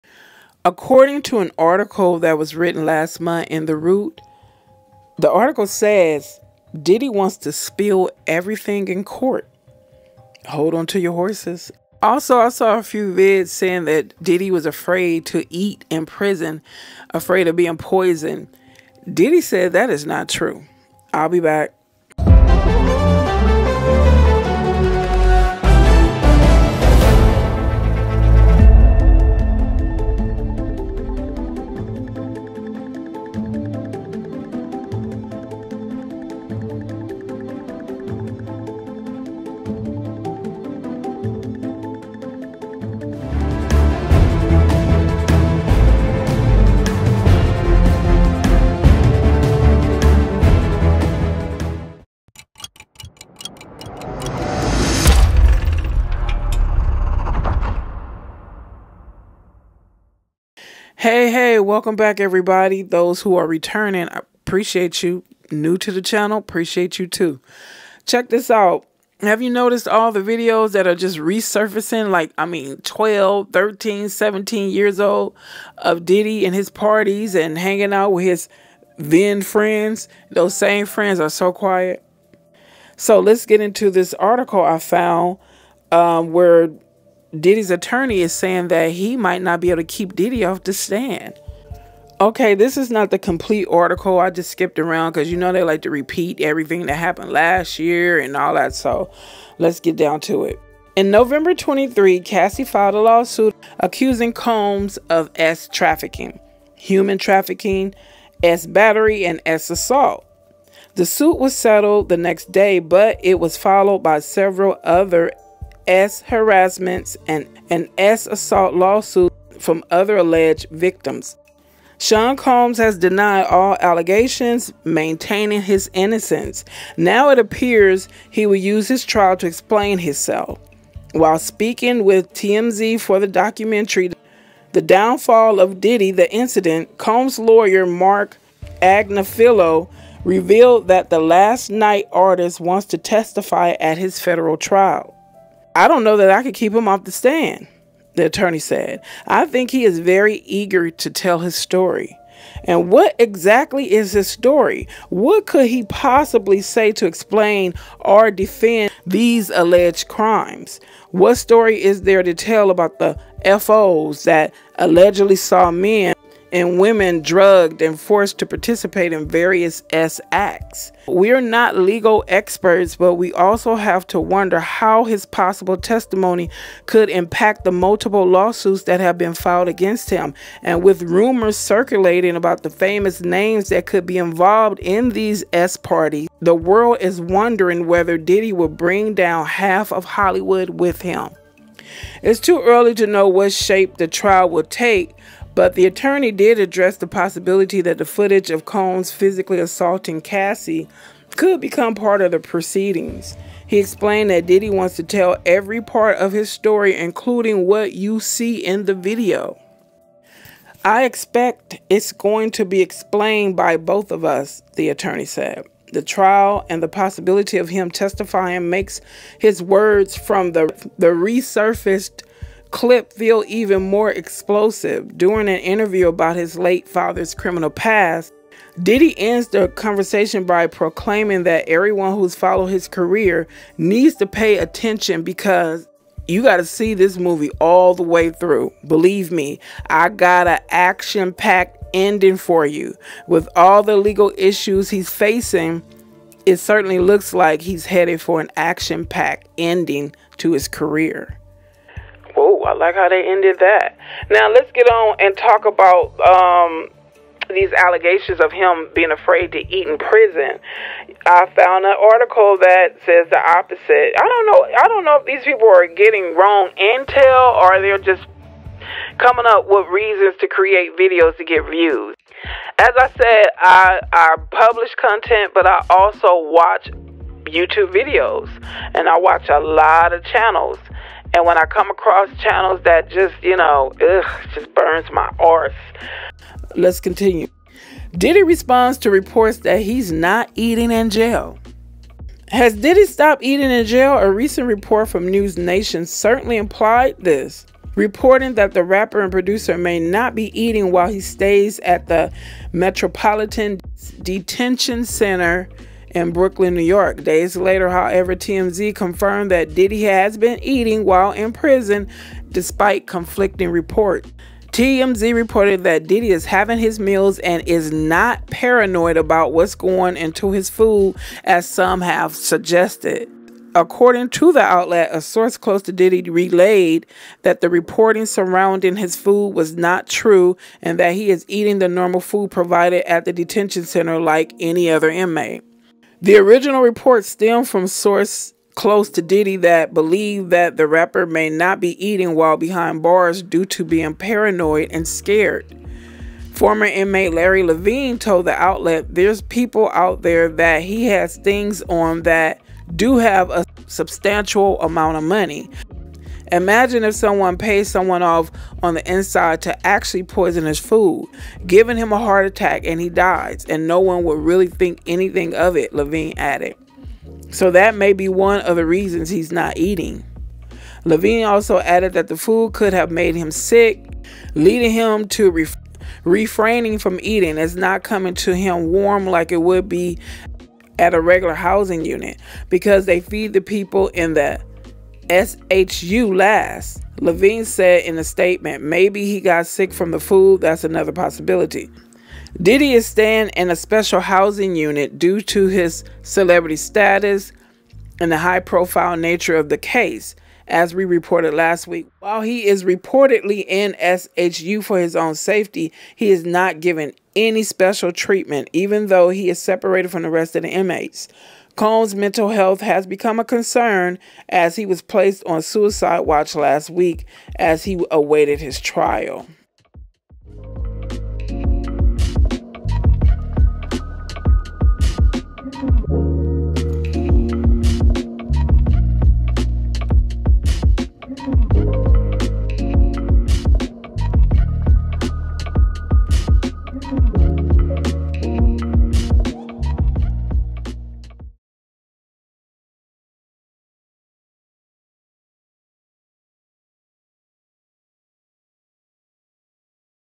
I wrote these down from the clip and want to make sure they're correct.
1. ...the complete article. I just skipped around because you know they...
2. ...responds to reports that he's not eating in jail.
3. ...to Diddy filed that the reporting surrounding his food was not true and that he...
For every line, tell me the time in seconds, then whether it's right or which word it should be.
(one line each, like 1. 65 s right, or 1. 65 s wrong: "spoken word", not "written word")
1. 93 s right
2. 288 s right
3. 325 s wrong: "relayed", not "filed".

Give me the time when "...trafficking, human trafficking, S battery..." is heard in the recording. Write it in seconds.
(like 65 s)
105 s.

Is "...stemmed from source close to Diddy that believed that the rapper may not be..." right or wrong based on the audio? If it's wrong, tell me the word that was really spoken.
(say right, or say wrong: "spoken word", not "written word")
right.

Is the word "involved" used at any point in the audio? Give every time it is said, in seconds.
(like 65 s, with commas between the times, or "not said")
184 s.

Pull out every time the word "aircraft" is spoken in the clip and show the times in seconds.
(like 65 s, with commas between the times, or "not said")
not said.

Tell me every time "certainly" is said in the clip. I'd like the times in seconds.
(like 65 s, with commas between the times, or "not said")
246 s, 296 s.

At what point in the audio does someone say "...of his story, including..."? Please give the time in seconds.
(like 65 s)
206 s.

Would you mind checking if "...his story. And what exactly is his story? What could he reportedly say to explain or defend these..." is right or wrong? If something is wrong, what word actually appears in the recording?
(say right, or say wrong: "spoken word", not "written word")
wrong: "possibly", not "reportedly".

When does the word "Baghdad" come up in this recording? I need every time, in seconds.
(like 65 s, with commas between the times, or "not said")
not said.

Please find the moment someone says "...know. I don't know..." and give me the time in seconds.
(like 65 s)
264 s.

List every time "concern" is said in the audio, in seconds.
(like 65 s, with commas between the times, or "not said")
413 s.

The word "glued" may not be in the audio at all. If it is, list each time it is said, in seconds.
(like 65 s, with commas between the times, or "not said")
not said.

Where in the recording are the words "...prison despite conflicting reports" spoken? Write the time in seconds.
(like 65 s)
311 s.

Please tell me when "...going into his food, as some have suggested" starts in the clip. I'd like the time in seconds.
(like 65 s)
319 s.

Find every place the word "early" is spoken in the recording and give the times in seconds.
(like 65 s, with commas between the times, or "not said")
192 s.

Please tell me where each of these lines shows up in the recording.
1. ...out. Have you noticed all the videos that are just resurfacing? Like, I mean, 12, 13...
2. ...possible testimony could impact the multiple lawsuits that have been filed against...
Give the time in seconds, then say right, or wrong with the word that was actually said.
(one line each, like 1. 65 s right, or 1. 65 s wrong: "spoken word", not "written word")
1. 68 s right
2. 175 s right.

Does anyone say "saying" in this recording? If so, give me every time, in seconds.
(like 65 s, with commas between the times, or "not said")
13 s, 88 s.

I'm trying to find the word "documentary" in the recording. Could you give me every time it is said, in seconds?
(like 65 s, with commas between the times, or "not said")
133 s.